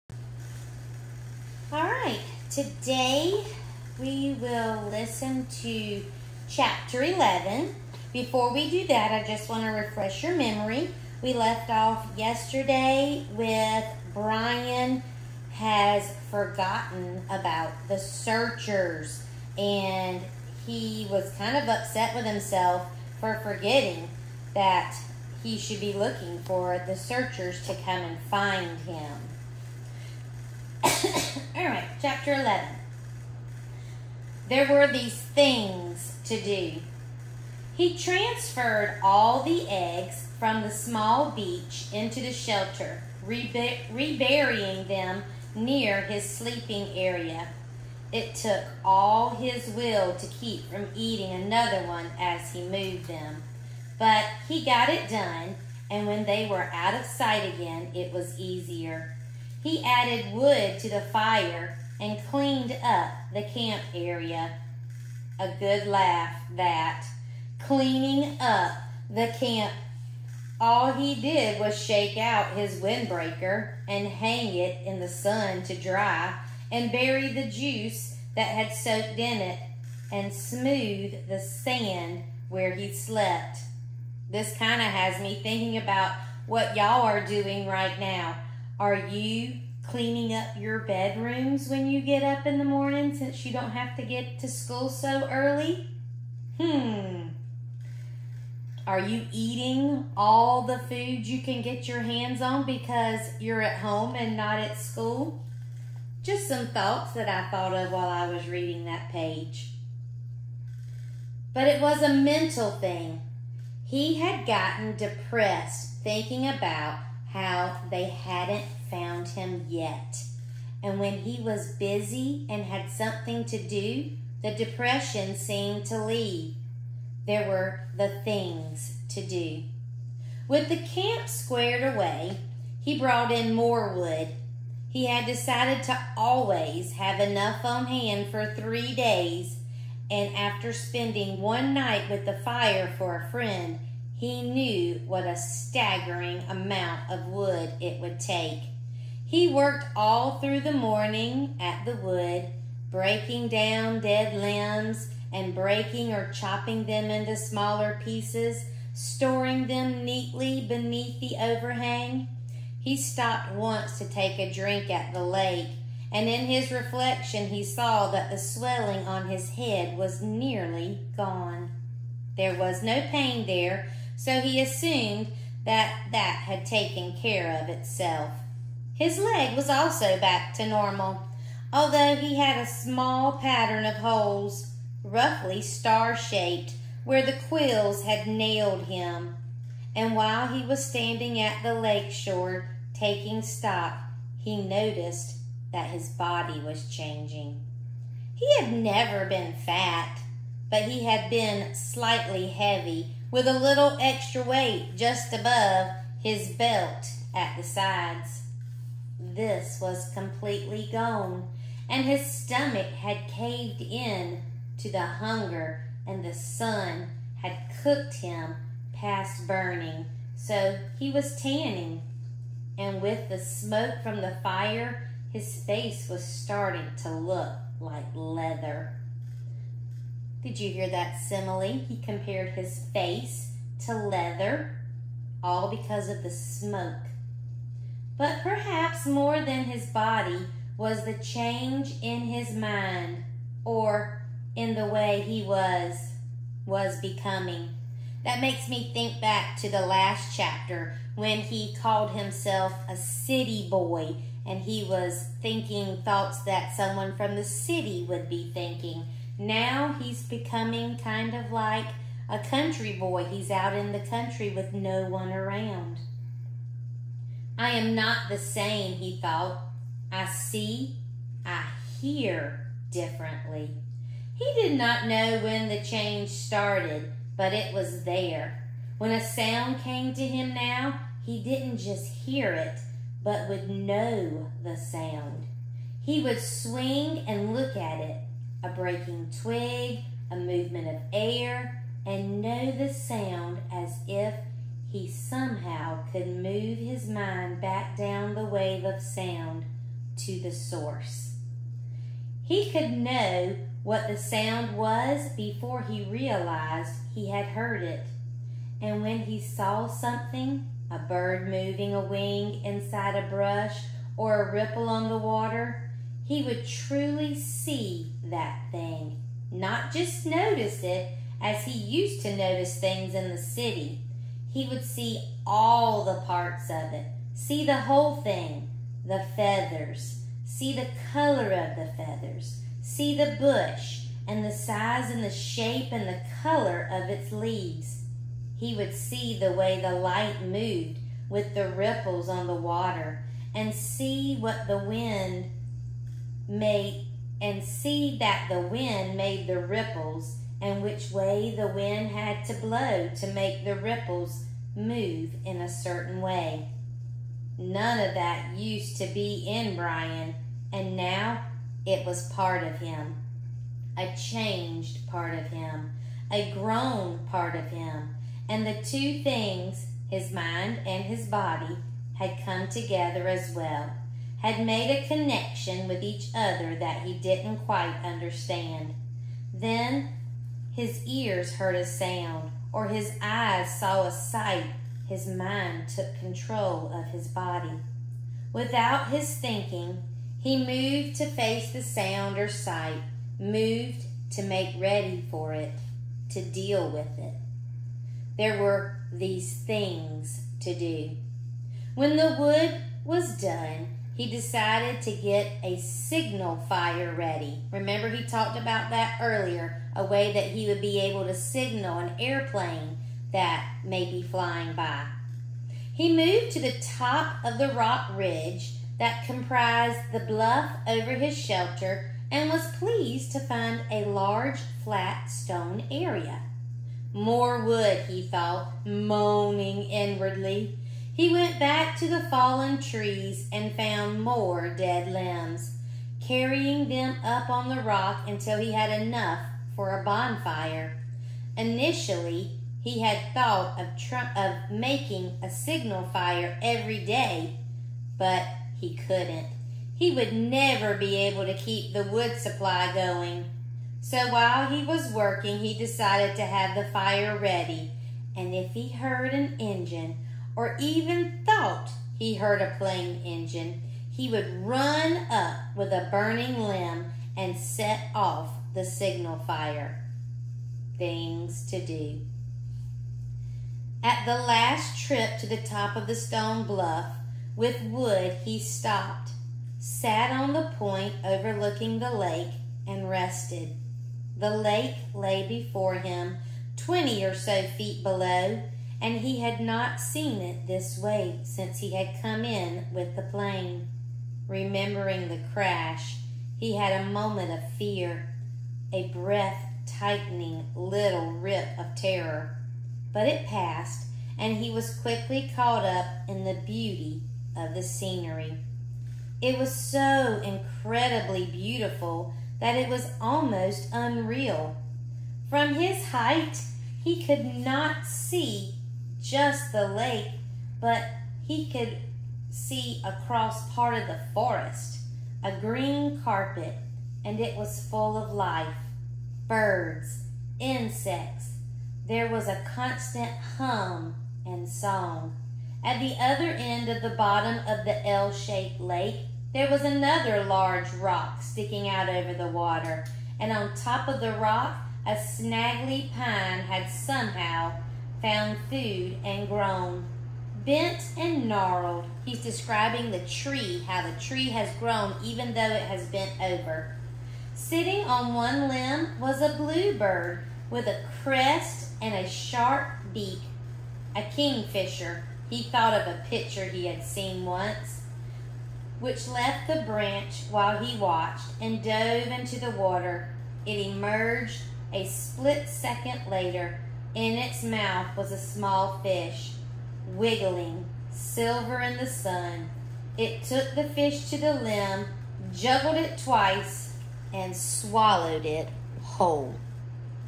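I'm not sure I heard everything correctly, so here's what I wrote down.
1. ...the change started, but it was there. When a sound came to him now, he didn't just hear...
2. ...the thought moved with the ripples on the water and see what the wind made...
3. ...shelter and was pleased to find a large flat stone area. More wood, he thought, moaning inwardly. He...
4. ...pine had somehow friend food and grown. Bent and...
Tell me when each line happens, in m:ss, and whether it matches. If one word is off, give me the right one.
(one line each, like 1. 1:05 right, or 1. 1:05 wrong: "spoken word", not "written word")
1. 4:35 right
2. 5:39 wrong: "light", not "thought"
3. 7:01 right
4. 9:06 wrong: "found", not "friend".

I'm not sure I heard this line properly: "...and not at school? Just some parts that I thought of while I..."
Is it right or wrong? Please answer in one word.
wrong.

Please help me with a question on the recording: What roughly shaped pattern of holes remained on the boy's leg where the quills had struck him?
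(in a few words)
Star-shaped.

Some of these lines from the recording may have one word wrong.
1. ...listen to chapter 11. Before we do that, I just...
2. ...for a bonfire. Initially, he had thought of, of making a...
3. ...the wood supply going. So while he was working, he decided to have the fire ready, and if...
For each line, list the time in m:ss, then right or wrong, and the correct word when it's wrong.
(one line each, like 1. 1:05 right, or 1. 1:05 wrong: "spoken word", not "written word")
1. 0:04 right
2. 7:19 right
3. 7:31 right.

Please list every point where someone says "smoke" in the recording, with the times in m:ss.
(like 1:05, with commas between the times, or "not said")
3:43, 3:56.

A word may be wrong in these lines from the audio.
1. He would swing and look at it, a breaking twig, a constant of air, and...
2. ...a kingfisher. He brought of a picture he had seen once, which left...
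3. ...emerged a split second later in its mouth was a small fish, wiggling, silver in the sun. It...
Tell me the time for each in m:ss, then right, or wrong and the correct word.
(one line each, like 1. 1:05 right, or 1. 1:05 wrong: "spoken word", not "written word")
1. 4:45 wrong: "movement", not "constant"
2. 9:24 wrong: "thought", not "brought"
3. 9:33 right.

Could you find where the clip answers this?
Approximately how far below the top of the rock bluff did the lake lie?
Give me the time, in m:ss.
8:06.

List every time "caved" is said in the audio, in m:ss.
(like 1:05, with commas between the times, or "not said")
3:33.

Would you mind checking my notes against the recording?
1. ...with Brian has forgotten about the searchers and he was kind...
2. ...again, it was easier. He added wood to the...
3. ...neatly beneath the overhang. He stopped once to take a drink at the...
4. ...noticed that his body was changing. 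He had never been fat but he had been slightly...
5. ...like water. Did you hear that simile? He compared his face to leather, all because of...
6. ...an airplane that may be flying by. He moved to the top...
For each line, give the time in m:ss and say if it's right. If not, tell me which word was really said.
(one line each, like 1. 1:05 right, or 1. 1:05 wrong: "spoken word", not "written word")
1. 0:13 right
2. 0:57 right
3. 2:40 right
4. 3:14 right
5. 3:47 wrong: "leather", not "water"
6. 6:51 right.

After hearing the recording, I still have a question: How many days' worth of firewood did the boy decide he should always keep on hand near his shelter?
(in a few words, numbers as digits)
3.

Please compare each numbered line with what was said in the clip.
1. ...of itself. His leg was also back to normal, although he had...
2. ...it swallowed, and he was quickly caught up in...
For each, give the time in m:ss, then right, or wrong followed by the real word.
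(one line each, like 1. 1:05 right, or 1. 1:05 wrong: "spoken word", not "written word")
1. 2:57 right
2. 8:23 wrong: "passed", not "swallowed".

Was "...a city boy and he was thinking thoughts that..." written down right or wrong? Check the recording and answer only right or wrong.
right.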